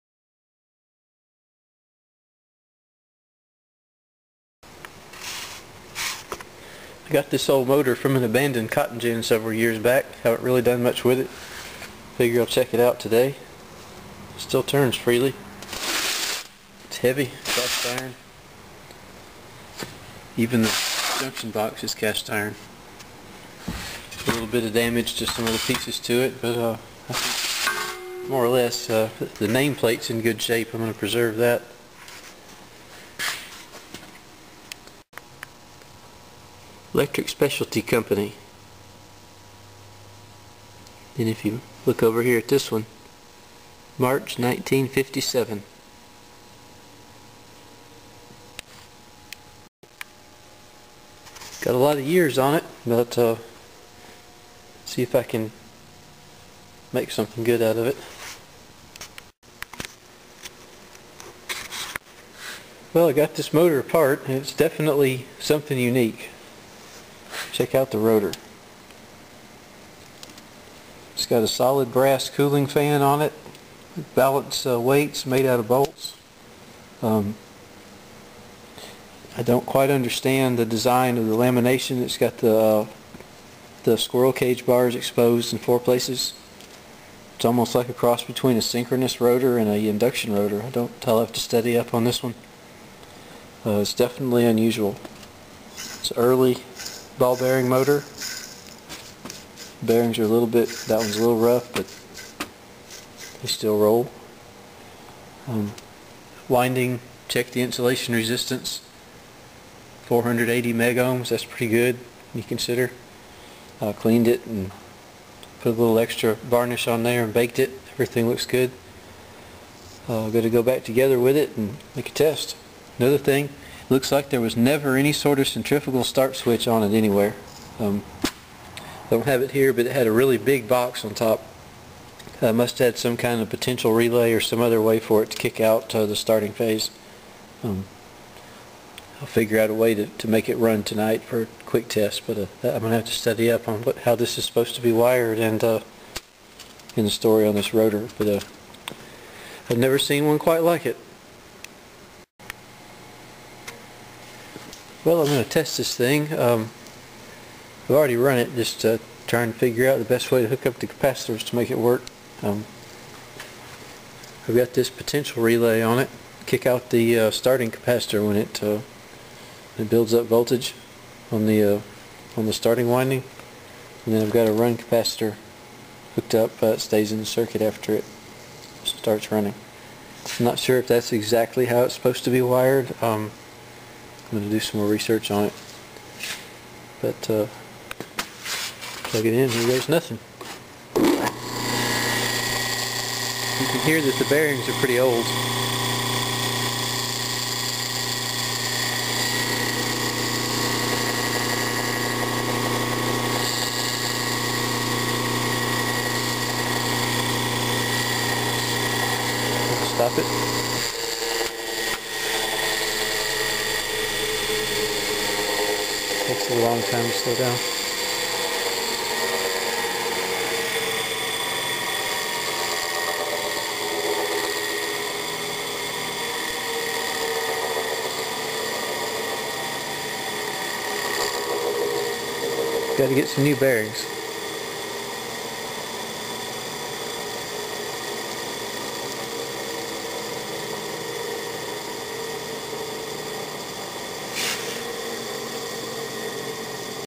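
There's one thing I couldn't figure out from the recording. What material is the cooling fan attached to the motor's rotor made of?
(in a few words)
Brass.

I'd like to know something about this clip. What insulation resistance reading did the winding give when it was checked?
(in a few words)
480 megohms.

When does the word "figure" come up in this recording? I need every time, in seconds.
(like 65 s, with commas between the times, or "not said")
12 s, 139 s, 159 s.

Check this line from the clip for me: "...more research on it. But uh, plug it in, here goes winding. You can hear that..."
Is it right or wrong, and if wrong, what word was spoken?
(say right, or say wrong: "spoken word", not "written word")
wrong: "nothing", not "winding".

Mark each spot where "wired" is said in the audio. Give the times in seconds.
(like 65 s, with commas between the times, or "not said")
144 s, 182 s.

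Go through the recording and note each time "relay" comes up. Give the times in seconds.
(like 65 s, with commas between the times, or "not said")
133 s, 165 s.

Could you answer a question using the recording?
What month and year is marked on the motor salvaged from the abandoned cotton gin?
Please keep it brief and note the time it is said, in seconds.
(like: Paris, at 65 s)
March 1957, at 43 s.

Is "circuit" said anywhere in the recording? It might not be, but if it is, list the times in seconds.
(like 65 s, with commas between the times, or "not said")
177 s.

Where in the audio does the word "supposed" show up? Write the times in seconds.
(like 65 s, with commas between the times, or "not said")
144 s, 181 s.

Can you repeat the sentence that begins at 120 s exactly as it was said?
Uh, got to go back together with it and make a test.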